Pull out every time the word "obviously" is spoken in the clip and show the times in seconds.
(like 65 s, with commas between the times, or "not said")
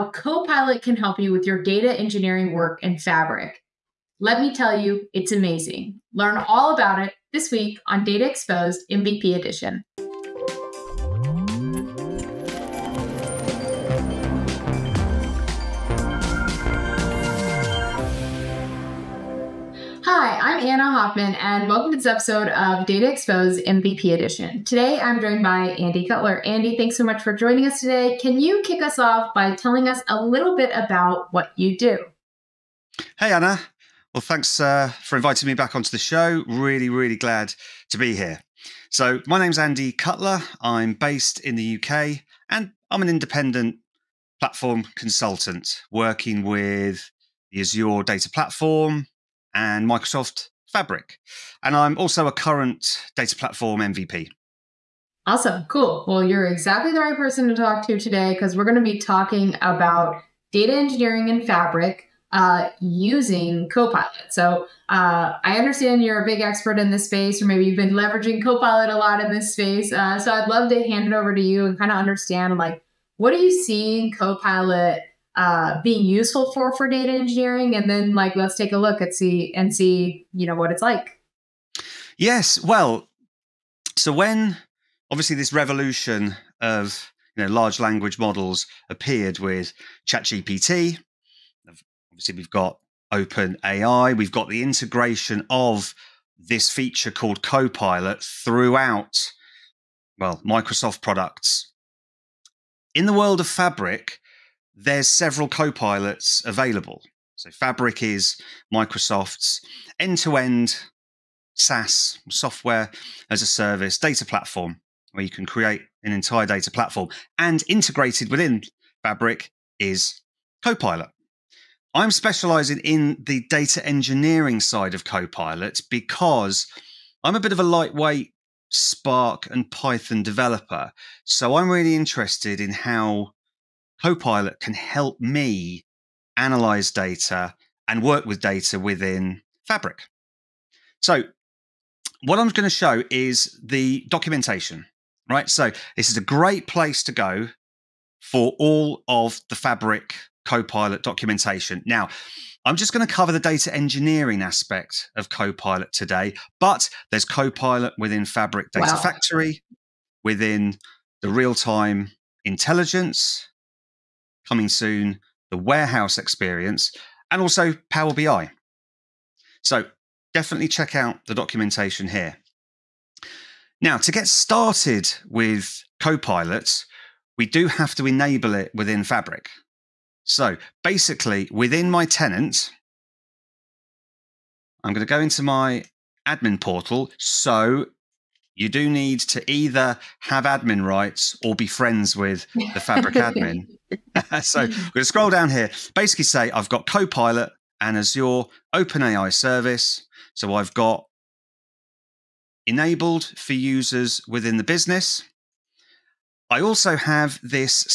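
85 s, 92 s.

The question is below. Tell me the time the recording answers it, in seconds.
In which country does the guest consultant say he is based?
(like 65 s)
41 s.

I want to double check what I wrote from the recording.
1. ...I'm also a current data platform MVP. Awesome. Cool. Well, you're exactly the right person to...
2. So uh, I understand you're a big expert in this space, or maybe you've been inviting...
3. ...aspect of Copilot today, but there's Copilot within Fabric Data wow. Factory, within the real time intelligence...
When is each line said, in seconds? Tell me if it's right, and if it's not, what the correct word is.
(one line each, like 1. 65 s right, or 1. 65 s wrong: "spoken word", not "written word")
1. 51 s right
2. 64 s wrong: "leveraging", not "inviting"
3. 154 s right.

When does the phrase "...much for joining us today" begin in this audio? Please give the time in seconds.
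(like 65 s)
27 s.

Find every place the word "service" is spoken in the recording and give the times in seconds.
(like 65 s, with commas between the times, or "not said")
113 s, 199 s.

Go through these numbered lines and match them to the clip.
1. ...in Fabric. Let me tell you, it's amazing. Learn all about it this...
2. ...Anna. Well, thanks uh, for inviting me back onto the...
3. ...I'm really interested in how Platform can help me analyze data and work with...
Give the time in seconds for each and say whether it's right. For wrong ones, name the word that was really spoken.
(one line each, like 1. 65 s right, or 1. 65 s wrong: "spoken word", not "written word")
1. 2 s right
2. 33 s right
3. 131 s wrong: "Copilot", not "Platform".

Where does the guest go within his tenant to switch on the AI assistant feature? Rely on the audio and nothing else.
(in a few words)
admin portal.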